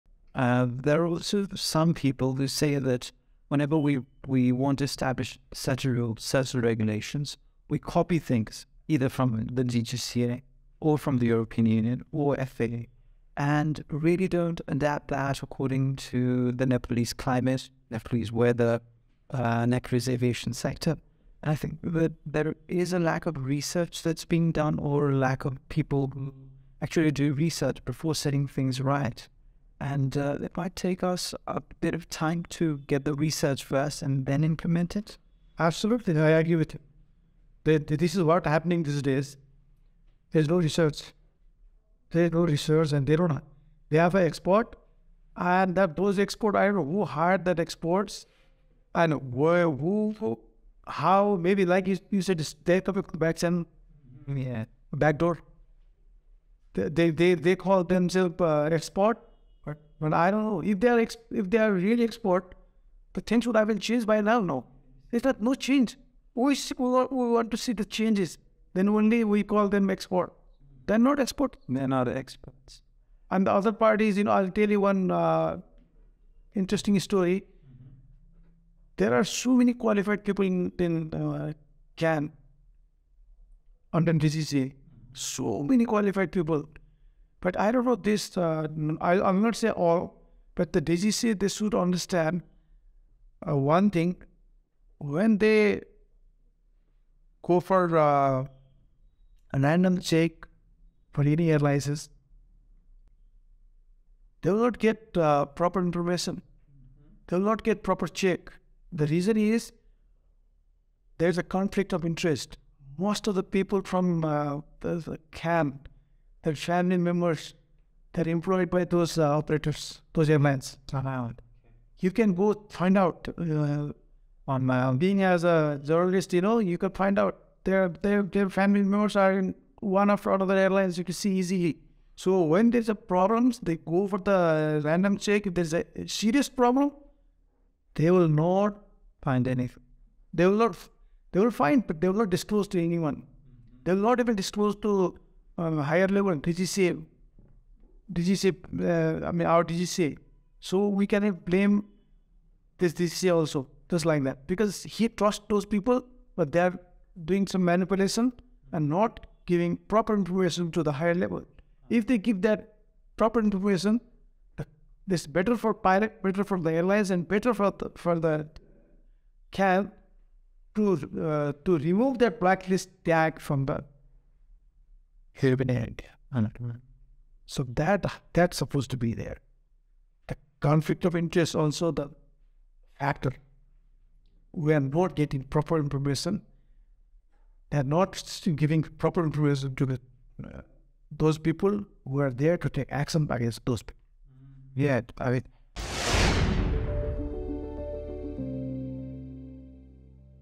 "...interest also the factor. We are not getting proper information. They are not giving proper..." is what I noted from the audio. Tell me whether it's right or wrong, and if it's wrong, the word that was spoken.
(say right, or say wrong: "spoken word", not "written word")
right.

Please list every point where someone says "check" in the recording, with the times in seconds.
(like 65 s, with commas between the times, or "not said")
99 s, 108 s, 135 s.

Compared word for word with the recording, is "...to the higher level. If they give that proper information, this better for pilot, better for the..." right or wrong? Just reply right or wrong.
right.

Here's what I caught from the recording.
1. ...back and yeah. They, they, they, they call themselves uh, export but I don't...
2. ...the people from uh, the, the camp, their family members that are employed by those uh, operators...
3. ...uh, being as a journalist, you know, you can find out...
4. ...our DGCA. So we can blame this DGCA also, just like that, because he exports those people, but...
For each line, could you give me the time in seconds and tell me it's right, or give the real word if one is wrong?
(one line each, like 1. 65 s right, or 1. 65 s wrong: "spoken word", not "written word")
1. 53 s right
2. 113 s right
3. 124 s right
4. 149 s wrong: "trusts", not "exports".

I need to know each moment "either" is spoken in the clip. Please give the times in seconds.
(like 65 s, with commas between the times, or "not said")
8 s.